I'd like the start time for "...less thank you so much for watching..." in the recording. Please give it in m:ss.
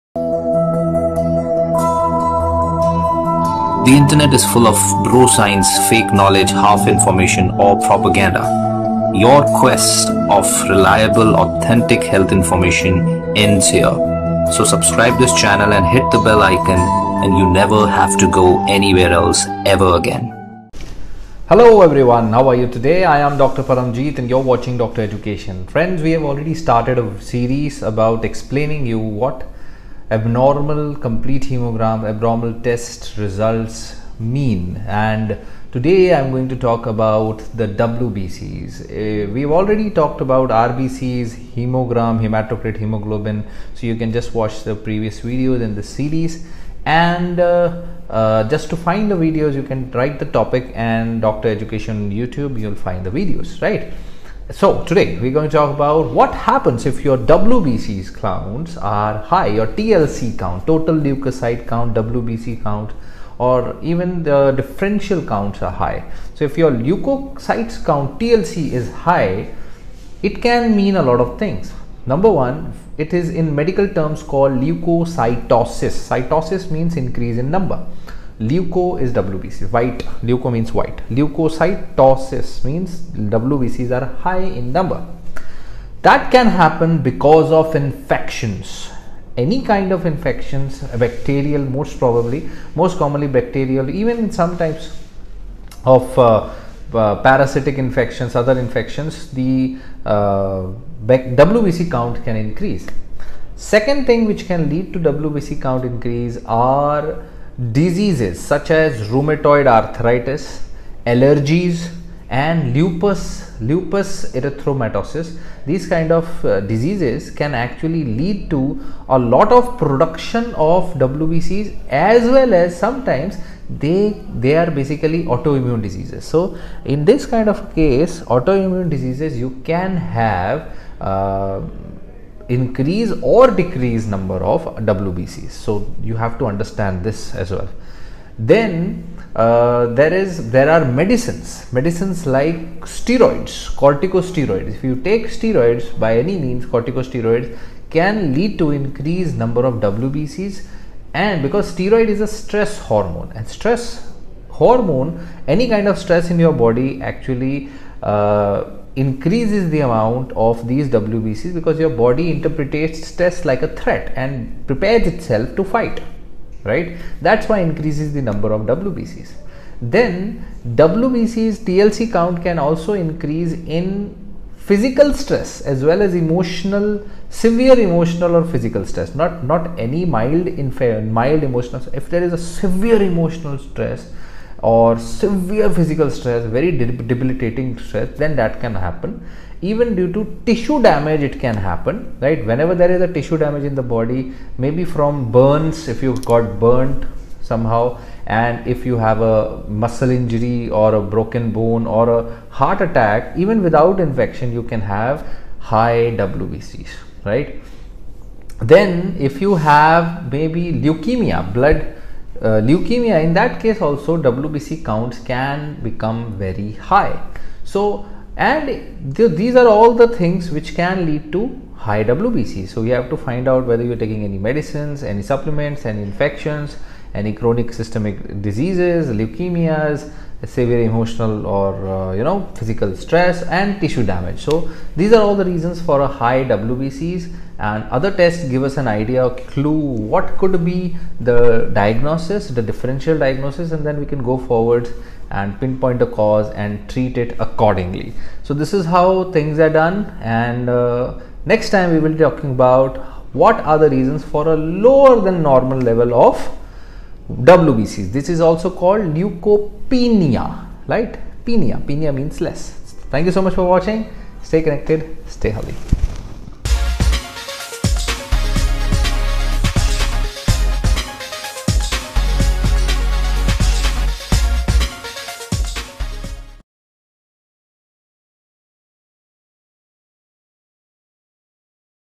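4:22.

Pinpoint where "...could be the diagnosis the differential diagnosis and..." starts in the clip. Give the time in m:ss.
4:00.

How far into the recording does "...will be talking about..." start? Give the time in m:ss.
4:11.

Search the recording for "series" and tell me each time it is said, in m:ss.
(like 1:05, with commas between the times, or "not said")
0:27, 0:45.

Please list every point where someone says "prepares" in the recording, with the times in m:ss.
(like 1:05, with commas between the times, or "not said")
2:44.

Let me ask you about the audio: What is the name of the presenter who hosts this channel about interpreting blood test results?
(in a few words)
Dr. Paramjeet.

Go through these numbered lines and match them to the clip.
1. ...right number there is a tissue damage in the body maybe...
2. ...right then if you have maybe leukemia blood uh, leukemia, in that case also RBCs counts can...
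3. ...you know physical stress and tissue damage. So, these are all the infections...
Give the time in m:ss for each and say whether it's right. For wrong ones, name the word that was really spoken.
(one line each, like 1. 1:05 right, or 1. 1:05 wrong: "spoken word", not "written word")
1. 3:12 wrong: "whenever", not "number"
2. 3:27 wrong: "WBC", not "RBCs"
3. 3:52 wrong: "reasons", not "infections".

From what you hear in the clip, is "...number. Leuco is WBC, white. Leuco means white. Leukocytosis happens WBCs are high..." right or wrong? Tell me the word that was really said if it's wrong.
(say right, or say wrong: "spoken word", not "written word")
wrong: "means", not "happens".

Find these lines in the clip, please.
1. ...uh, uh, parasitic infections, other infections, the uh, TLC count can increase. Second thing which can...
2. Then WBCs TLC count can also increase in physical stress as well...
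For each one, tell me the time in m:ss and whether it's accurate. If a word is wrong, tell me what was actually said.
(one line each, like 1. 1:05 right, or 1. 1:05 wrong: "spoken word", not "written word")
1. 1:36 wrong: "WBC", not "TLC"
2. 2:49 right.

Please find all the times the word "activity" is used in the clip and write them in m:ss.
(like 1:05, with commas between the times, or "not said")
not said.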